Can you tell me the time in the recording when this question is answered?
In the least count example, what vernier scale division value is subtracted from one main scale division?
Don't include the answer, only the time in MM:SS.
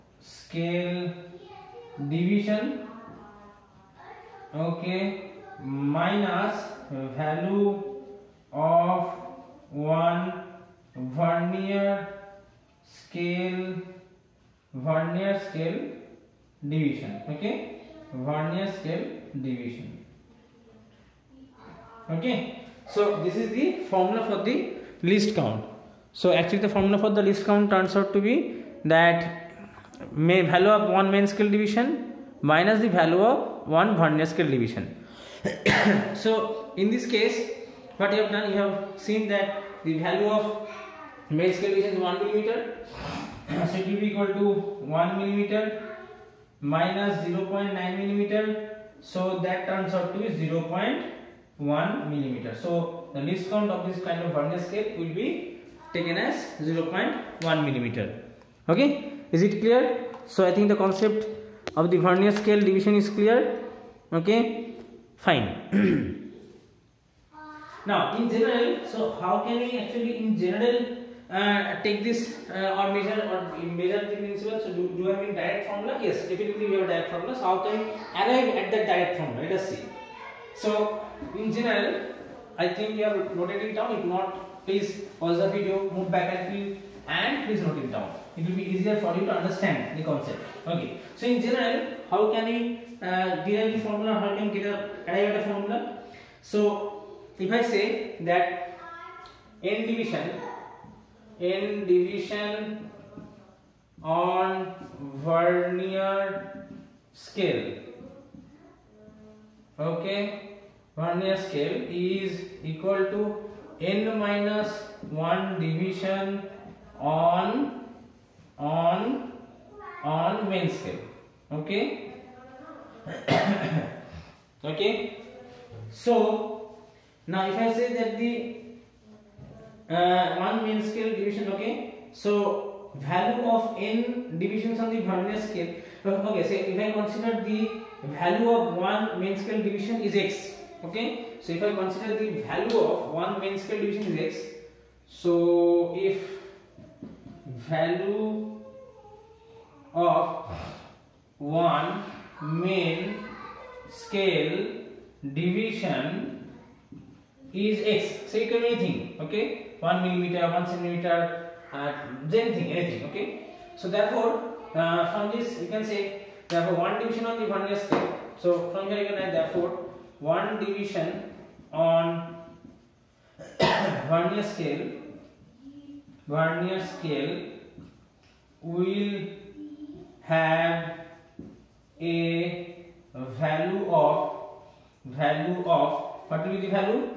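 00:47.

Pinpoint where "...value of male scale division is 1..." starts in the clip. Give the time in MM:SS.
00:39.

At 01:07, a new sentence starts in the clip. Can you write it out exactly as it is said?
now, in general, so how can we actually in general uh, take this uh, or measure or measure the principle?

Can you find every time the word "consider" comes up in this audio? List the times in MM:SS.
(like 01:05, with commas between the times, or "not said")
02:16, 02:21.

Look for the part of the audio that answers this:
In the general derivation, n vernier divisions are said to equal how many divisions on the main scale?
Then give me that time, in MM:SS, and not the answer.
01:53.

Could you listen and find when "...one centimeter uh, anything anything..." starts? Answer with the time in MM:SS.
02:40.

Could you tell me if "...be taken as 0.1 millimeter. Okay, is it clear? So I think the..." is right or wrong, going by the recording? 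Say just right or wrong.
right.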